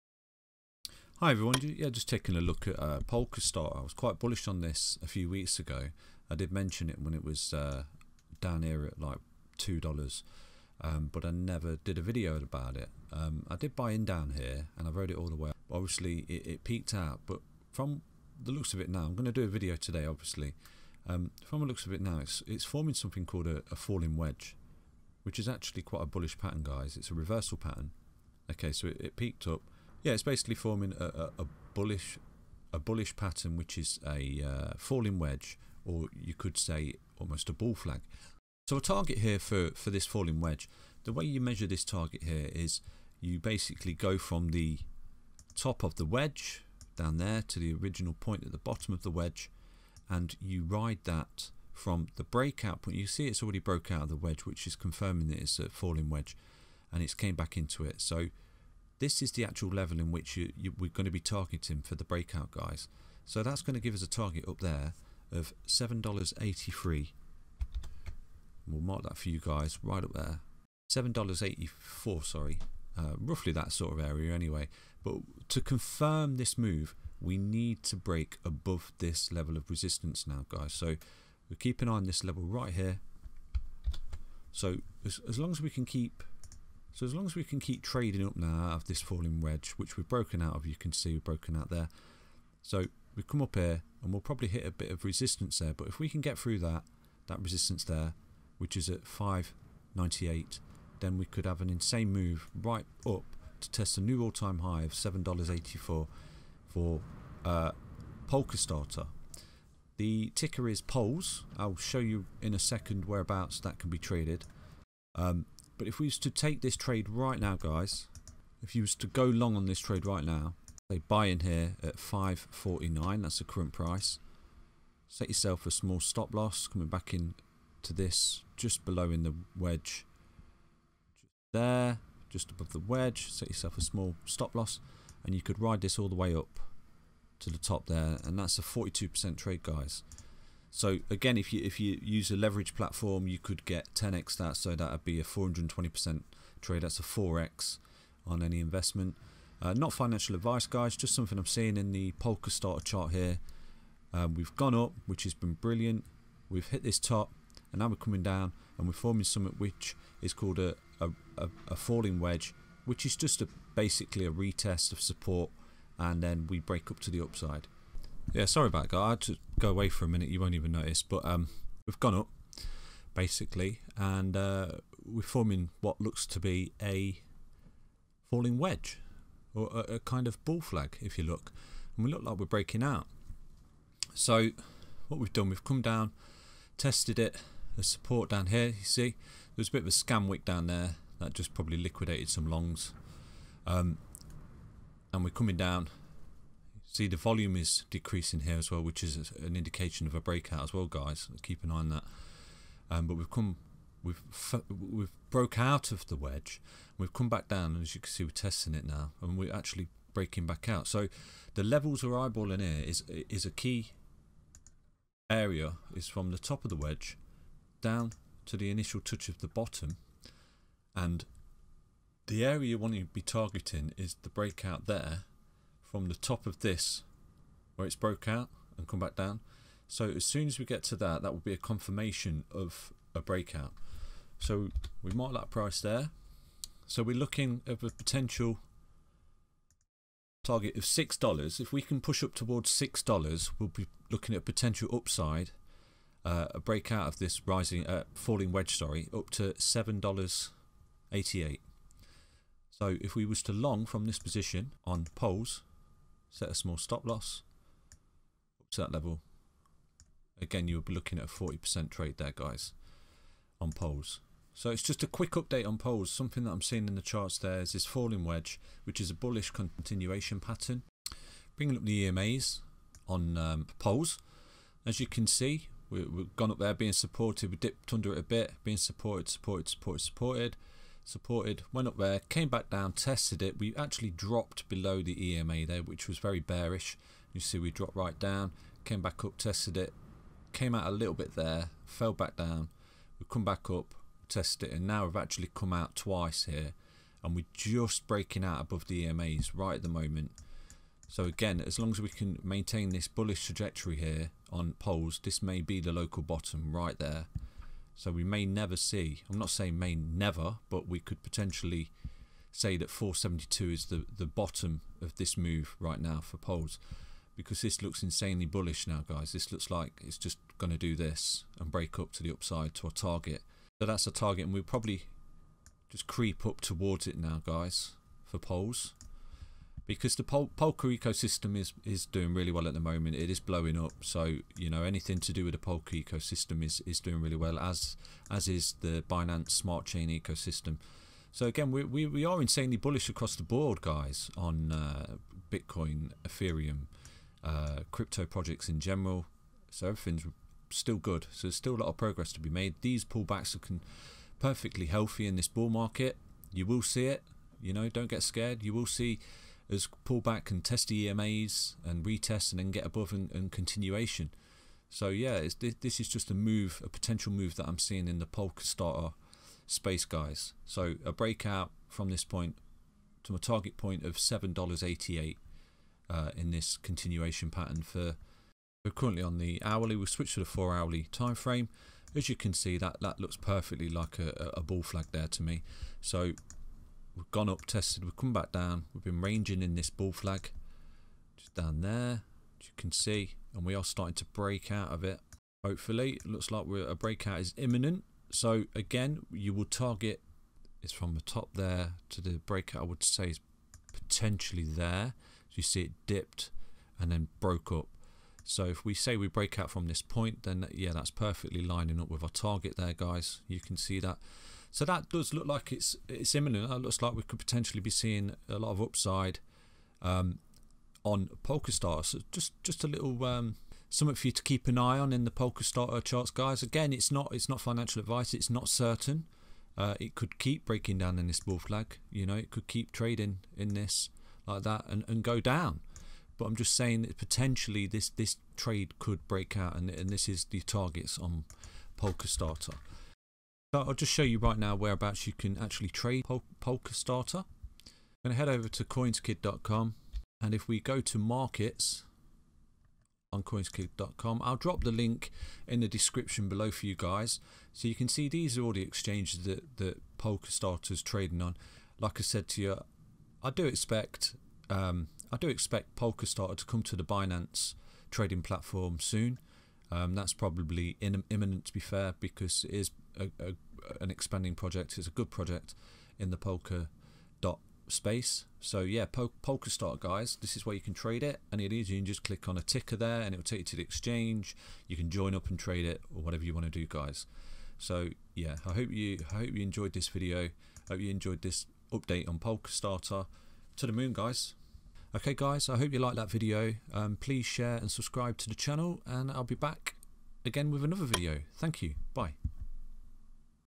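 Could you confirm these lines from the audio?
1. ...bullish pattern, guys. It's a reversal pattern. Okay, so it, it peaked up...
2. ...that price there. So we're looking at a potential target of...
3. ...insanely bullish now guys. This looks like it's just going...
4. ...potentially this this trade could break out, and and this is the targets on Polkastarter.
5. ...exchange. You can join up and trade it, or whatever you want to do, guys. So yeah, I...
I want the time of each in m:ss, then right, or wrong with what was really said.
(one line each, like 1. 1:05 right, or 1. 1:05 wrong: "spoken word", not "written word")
1. 0:26 right
2. 3:55 right
3. 5:18 right
4. 7:17 right
5. 8:03 right.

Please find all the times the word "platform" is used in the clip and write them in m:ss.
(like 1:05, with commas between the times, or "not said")
2:22, 7:48.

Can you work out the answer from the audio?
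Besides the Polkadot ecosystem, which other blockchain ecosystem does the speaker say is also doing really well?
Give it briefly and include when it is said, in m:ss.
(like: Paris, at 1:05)
Binance Smart Chain, at 5:39.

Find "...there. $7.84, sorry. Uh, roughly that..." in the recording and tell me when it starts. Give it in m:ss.
1:10.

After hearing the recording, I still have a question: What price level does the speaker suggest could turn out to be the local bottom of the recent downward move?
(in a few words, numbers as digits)
472.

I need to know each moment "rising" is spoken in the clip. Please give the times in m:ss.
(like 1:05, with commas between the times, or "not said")
4:07.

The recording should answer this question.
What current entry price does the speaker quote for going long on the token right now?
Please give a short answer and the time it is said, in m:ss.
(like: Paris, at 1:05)
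5.49, at 2:01.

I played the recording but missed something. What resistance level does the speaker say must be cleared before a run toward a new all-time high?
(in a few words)
598.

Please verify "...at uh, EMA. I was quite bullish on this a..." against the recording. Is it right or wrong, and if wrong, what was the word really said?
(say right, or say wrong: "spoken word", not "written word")
wrong: "Polkastar", not "EMA".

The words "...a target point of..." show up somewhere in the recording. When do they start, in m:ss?
6:13.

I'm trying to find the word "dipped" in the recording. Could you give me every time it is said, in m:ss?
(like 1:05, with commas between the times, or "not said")
4:37, 6:46.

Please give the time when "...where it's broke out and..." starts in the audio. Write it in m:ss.
3:47.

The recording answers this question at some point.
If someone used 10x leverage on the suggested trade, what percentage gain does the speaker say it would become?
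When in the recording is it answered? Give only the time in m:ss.
2:25.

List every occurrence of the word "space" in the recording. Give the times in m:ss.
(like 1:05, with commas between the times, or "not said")
6:09, 7:57.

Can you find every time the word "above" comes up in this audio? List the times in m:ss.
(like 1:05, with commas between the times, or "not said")
1:18, 2:12, 4:58, 6:02.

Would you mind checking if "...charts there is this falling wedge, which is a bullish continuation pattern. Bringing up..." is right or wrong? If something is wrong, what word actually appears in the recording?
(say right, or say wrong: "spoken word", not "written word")
right.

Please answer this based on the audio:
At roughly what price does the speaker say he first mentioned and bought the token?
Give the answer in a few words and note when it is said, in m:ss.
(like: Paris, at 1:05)
$2, at 0:09.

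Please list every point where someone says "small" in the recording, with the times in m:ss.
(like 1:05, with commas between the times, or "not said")
2:05, 2:13, 4:16.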